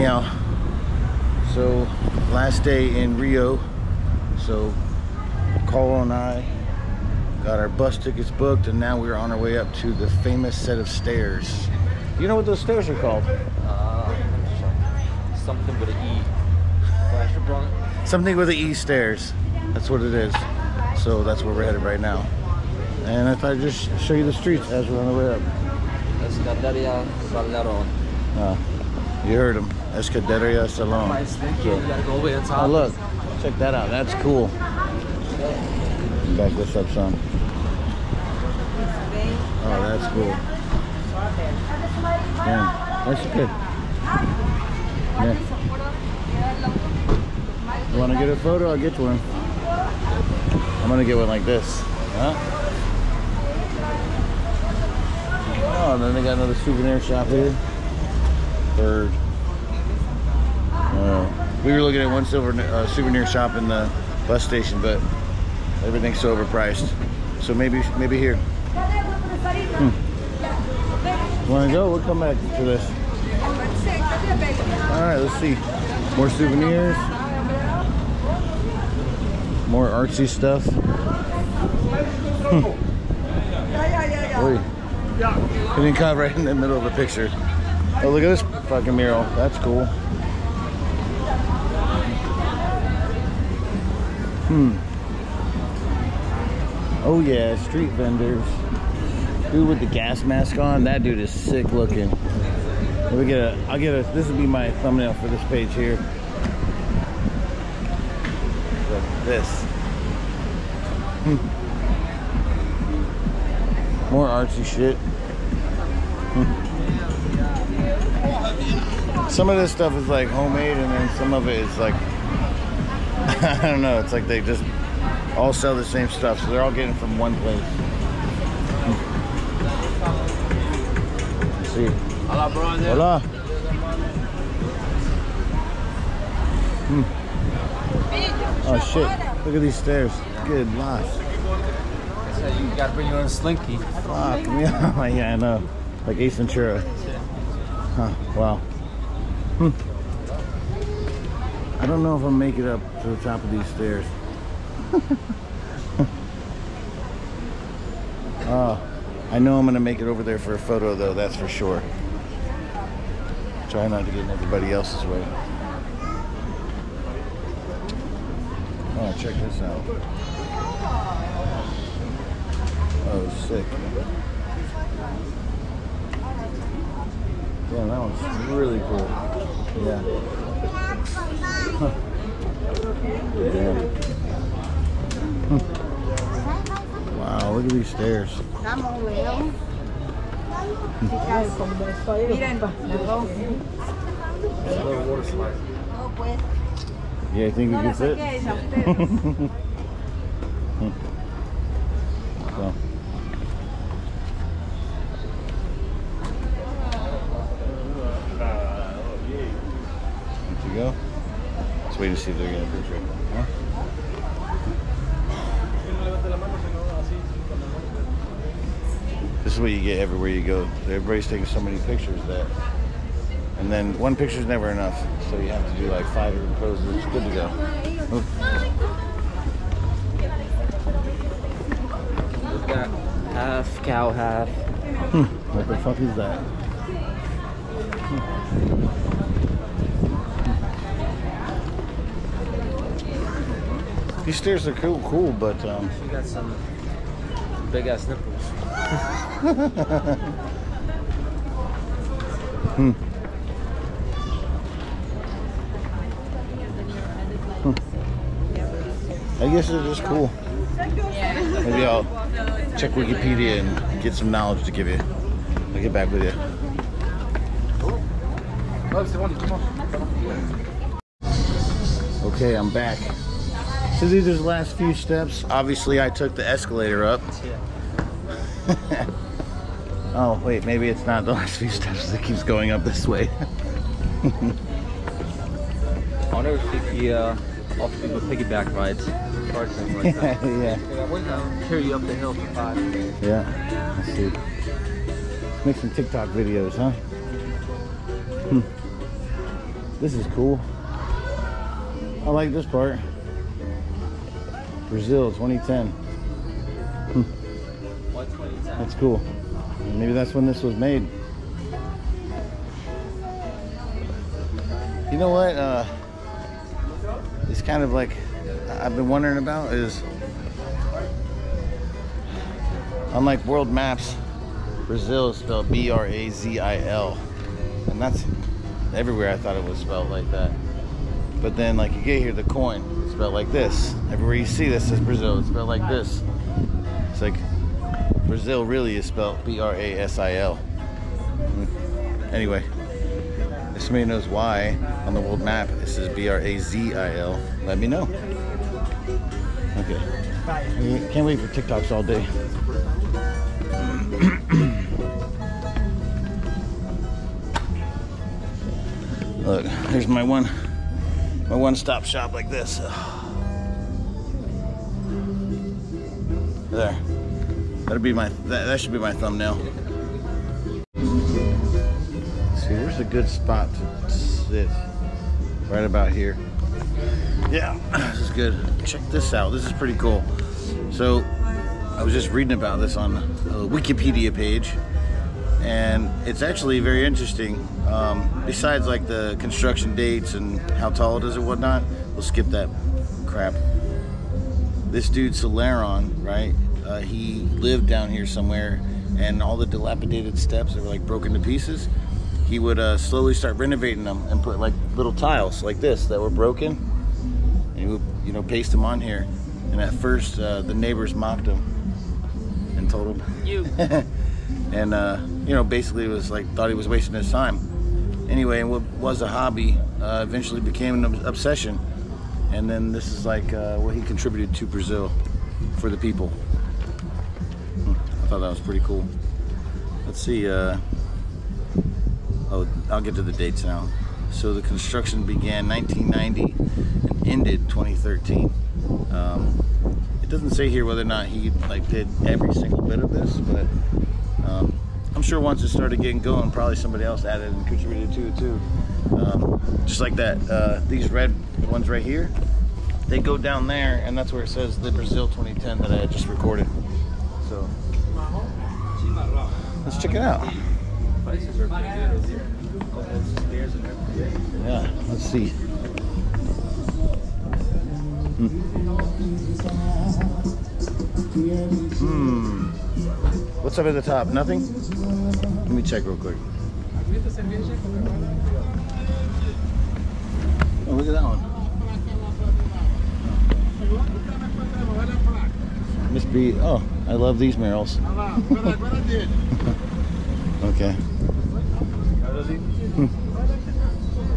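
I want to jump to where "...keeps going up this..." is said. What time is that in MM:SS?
04:42.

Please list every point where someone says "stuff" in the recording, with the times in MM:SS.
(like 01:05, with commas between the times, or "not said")
01:20, 01:59, 02:06.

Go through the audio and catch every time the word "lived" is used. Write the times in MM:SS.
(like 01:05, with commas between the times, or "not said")
06:37.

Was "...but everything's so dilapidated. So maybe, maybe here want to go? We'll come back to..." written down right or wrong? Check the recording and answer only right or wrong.
wrong.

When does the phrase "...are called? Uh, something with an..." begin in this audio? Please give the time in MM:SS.
00:12.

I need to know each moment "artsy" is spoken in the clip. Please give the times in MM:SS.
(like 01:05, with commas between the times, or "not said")
01:19, 01:54.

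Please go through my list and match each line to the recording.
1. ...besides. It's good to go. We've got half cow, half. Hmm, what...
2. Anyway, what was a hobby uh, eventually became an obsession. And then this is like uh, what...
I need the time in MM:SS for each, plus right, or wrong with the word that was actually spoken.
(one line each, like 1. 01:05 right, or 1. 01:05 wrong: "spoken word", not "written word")
1. 03:46 wrong: "poses", not "besides"
2. 06:58 right.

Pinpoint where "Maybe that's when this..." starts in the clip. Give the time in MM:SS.
05:09.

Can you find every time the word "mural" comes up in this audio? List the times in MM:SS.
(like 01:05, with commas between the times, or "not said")
01:28, 08:07.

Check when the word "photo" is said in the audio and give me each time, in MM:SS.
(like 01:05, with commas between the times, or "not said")
00:48, 02:40.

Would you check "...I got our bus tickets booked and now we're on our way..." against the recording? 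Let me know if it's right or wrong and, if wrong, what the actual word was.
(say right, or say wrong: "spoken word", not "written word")
right.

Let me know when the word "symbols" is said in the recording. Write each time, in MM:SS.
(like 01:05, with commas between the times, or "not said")
not said.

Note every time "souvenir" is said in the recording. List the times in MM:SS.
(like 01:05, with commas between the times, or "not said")
00:56, 01:02, 01:16.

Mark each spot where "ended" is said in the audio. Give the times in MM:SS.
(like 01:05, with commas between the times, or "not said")
07:17.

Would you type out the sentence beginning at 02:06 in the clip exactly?
So they're all getting from one place.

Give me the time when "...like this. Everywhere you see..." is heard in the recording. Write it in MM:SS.
05:33.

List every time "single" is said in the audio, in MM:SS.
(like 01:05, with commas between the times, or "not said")
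07:22.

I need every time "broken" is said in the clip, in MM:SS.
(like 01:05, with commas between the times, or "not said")
06:41, 06:46.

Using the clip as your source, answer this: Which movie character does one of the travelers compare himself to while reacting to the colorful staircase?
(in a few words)
Ace Ventura.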